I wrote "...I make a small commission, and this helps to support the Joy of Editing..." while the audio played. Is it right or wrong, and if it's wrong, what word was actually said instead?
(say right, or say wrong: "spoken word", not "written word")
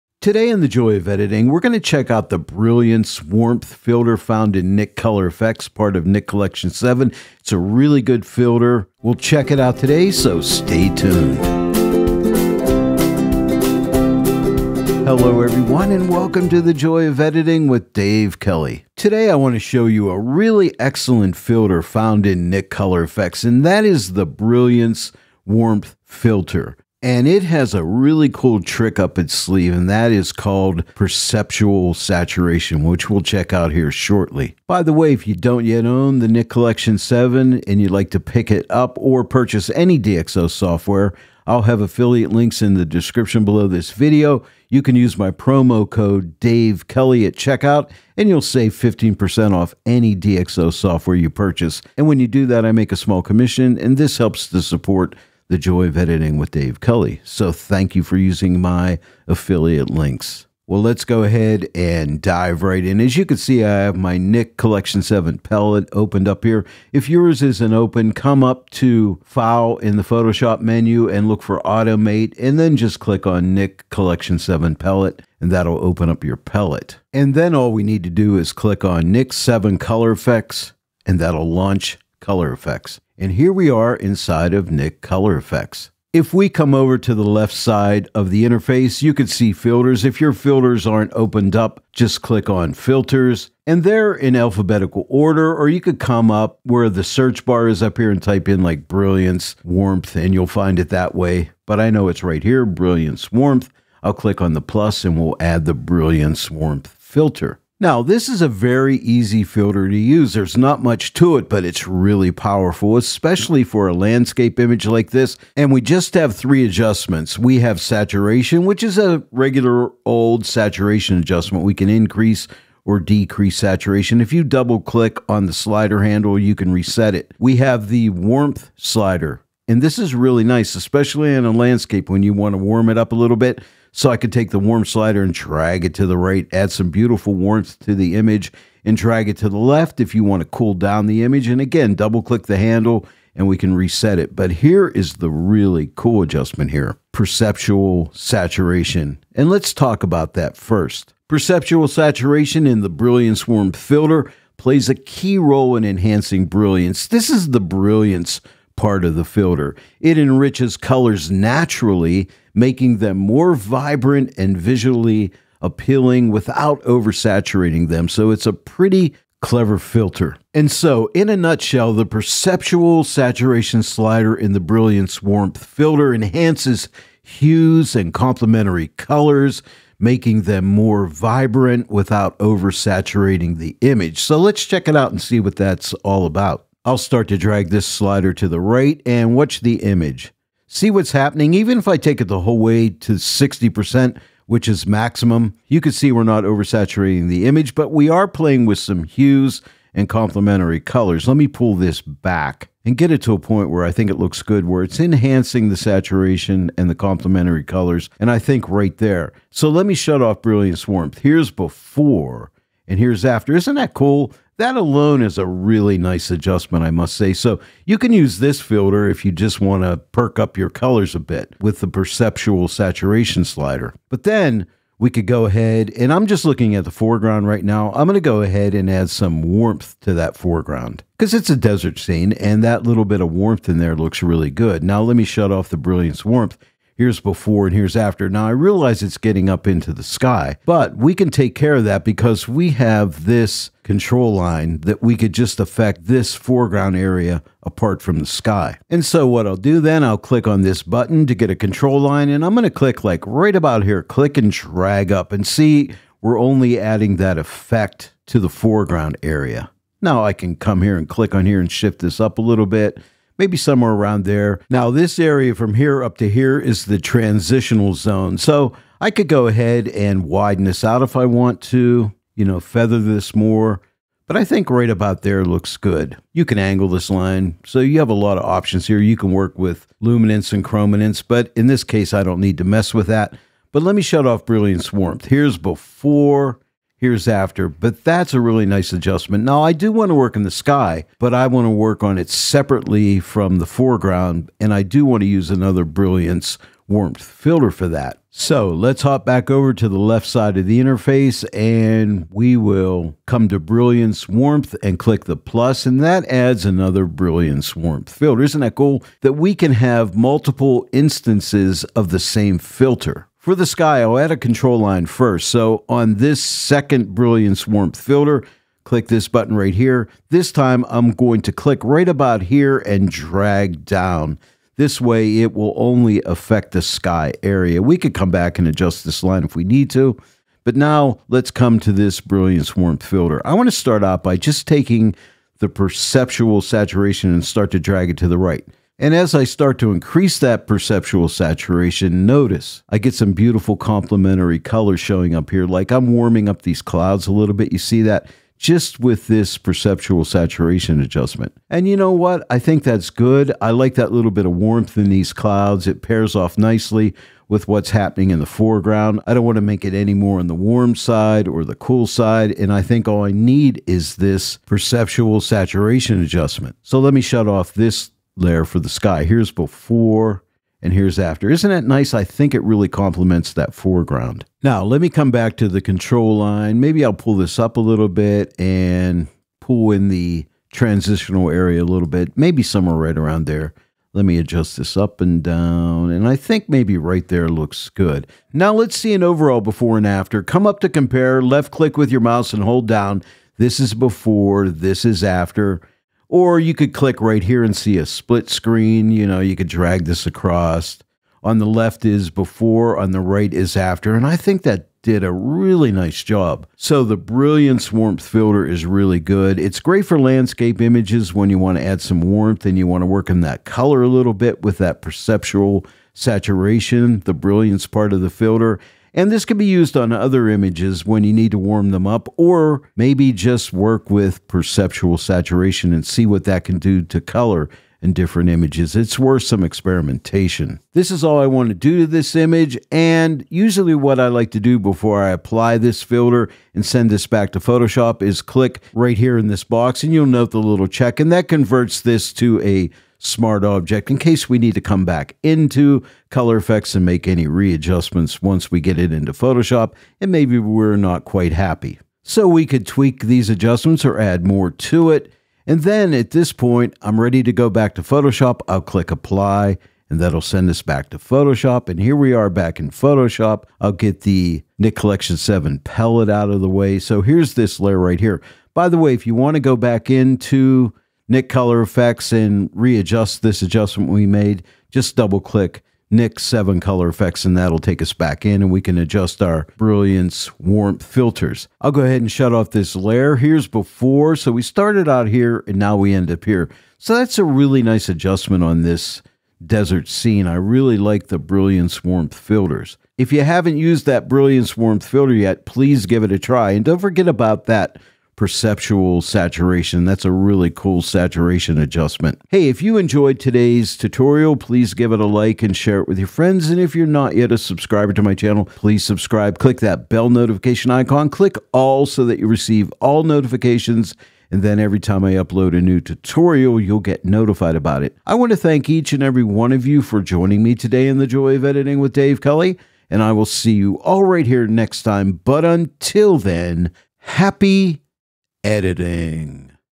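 right.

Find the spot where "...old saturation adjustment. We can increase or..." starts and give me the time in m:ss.
2:00.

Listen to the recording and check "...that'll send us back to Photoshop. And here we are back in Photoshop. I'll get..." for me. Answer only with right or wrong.
right.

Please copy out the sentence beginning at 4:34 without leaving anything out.
But I think right about there looks good.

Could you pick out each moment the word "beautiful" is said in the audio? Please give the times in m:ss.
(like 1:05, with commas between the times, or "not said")
2:16, 5:43.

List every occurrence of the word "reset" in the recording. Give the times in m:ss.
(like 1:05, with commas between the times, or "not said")
2:06, 2:23.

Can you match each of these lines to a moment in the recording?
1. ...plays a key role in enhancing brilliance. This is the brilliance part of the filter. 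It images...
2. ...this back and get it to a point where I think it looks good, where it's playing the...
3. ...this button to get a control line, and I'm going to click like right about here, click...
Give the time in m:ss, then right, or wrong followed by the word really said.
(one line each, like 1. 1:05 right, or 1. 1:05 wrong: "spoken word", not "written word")
1. 2:34 wrong: "enriches", not "images"
2. 3:21 wrong: "enhancing", not "playing"
3. 4:10 right.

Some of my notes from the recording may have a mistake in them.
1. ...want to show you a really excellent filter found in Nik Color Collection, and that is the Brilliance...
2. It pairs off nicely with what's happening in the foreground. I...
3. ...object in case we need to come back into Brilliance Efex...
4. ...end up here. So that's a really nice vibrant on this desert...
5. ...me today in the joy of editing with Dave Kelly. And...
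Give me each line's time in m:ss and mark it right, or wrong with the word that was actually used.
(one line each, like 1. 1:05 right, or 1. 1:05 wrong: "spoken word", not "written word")
1. 0:19 wrong: "Efex", not "Collection"
2. 5:55 right
3. 7:23 wrong: "Color", not "Brilliance"
4. 8:06 wrong: "adjustment", not "vibrant"
5. 8:40 right.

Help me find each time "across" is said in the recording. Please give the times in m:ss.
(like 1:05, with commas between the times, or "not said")
6:40.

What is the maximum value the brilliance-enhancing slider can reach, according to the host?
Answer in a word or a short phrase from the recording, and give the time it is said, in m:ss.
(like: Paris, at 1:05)
60%, at 3:13.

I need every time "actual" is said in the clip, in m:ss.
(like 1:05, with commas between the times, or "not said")
not said.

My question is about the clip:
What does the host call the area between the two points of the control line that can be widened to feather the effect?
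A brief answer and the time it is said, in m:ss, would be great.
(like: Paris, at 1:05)
transitional zone, at 4:26.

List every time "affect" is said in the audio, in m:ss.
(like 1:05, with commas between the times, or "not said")
4:05, 5:26.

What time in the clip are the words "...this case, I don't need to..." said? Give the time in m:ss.
4:41.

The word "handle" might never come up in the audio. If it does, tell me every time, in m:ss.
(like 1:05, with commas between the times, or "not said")
2:06, 2:22.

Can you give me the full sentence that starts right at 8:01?
I'll go ahead and shut off this layer.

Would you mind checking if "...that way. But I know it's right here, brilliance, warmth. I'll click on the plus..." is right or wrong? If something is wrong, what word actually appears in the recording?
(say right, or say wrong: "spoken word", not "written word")
right.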